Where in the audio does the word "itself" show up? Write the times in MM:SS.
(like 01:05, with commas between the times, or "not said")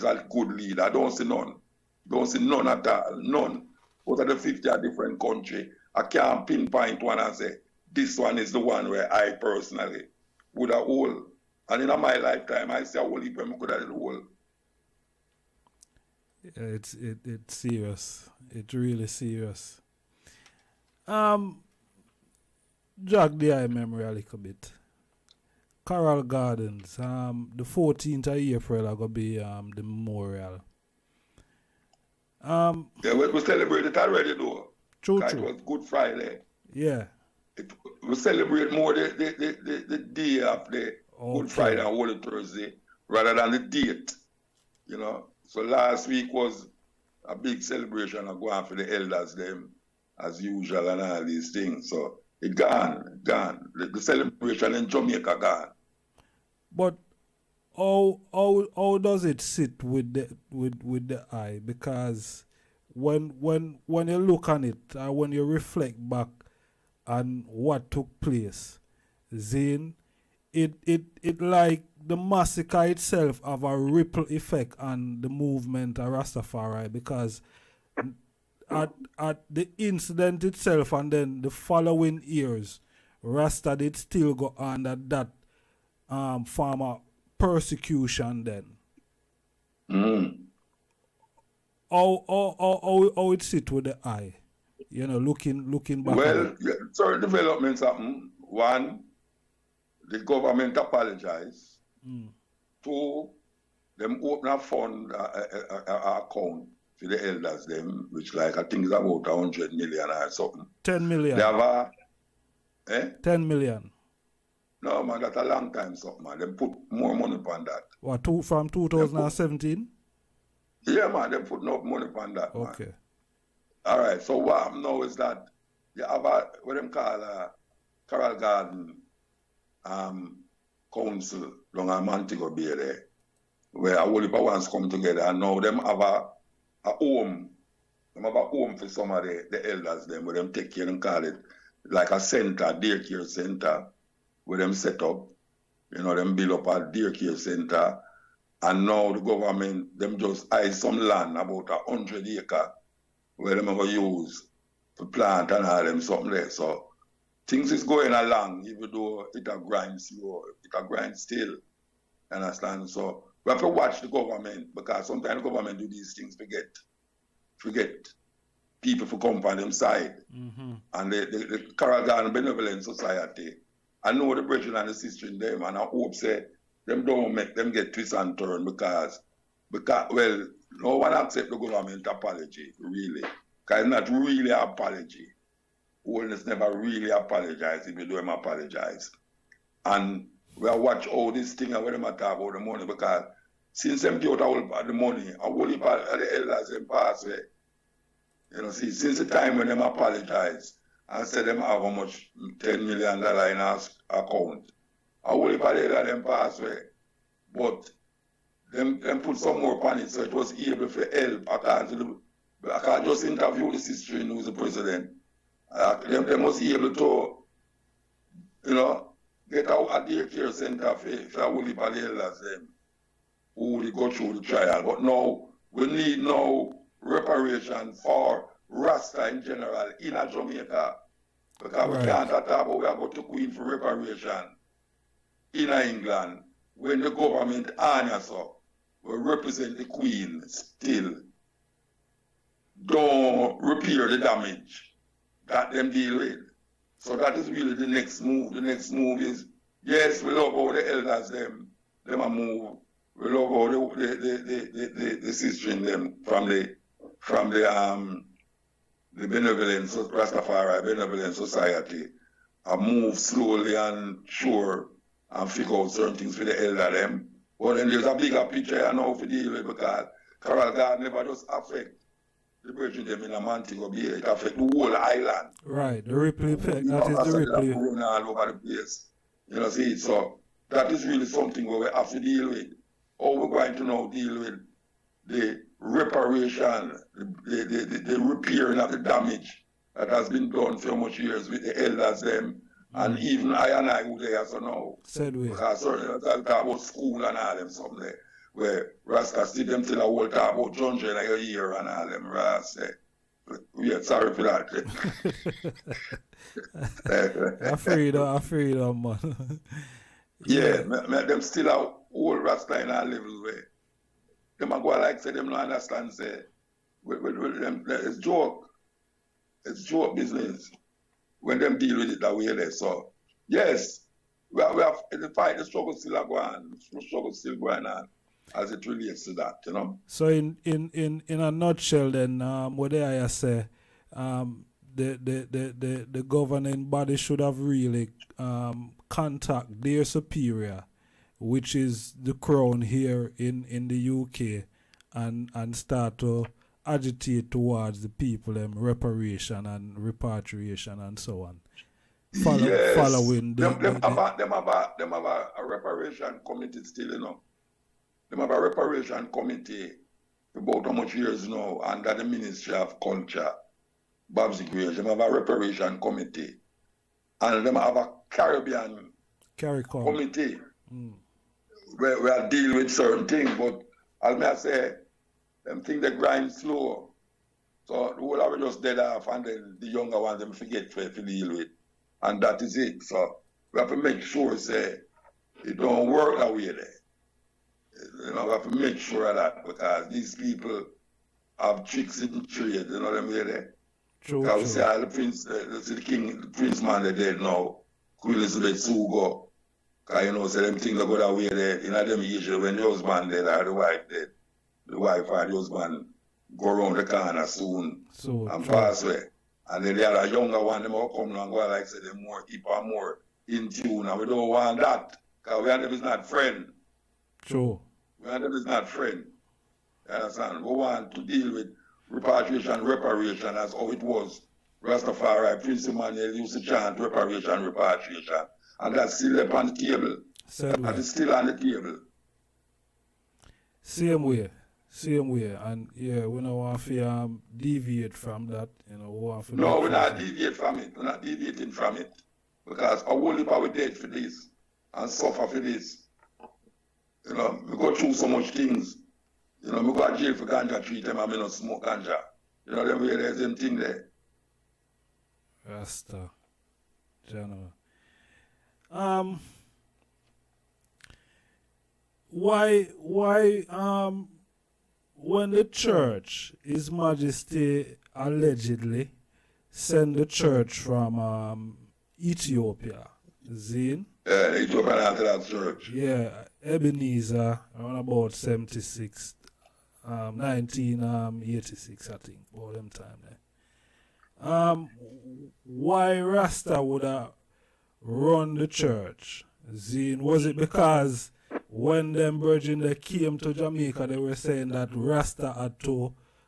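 01:12, 01:20.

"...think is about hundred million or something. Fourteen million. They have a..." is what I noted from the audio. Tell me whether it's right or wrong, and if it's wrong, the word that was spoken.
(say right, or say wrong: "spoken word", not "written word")
wrong: "Ten", not "Fourteen".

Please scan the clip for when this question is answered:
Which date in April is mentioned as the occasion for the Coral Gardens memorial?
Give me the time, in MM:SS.
00:27.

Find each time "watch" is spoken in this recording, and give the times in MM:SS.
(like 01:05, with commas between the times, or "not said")
02:43, 03:10.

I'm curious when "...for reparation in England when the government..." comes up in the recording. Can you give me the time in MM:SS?
03:53.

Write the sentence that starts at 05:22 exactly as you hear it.
So yes, we have, we have the fight, the struggle still are going on.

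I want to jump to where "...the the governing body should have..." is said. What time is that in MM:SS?
05:35.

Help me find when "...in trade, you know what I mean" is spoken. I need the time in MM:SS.
06:32.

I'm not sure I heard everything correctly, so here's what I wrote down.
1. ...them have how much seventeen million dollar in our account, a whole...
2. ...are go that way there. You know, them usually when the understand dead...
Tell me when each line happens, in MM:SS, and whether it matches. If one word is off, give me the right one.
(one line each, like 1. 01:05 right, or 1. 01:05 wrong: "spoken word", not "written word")
1. 03:21 wrong: "ten", not "seventeen"
2. 06:41 wrong: "husband", not "understand".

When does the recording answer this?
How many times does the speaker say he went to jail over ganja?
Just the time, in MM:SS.
07:30.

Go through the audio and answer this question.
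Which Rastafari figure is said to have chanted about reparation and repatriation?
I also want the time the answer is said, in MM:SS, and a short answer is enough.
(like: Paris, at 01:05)
Prince Emmanuel, at 07:05.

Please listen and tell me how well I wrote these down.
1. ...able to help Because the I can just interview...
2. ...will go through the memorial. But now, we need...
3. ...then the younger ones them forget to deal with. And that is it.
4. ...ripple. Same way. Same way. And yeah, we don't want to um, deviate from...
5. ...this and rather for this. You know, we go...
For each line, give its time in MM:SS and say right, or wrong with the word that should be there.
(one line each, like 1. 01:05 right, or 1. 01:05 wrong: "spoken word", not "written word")
1. 03:30 right
2. 03:43 wrong: "trial", not "memorial"
3. 06:19 right
4. 07:11 wrong: "table", not "ripple"
5. 07:24 wrong: "suffer", not "rather".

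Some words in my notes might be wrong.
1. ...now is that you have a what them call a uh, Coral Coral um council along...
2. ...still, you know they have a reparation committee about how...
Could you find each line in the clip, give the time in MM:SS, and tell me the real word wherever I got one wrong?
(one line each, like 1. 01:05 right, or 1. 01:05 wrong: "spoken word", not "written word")
1. 02:04 wrong: "Garden", not "Coral"
2. 05:56 right.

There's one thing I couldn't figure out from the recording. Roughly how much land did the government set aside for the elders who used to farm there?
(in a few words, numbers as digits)
100 acres.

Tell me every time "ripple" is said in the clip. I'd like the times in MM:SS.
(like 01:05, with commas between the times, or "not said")
01:13.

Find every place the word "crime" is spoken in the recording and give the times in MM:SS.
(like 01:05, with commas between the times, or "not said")
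not said.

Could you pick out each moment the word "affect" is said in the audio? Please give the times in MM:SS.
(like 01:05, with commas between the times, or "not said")
04:31.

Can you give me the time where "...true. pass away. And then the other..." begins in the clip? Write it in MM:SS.
06:48.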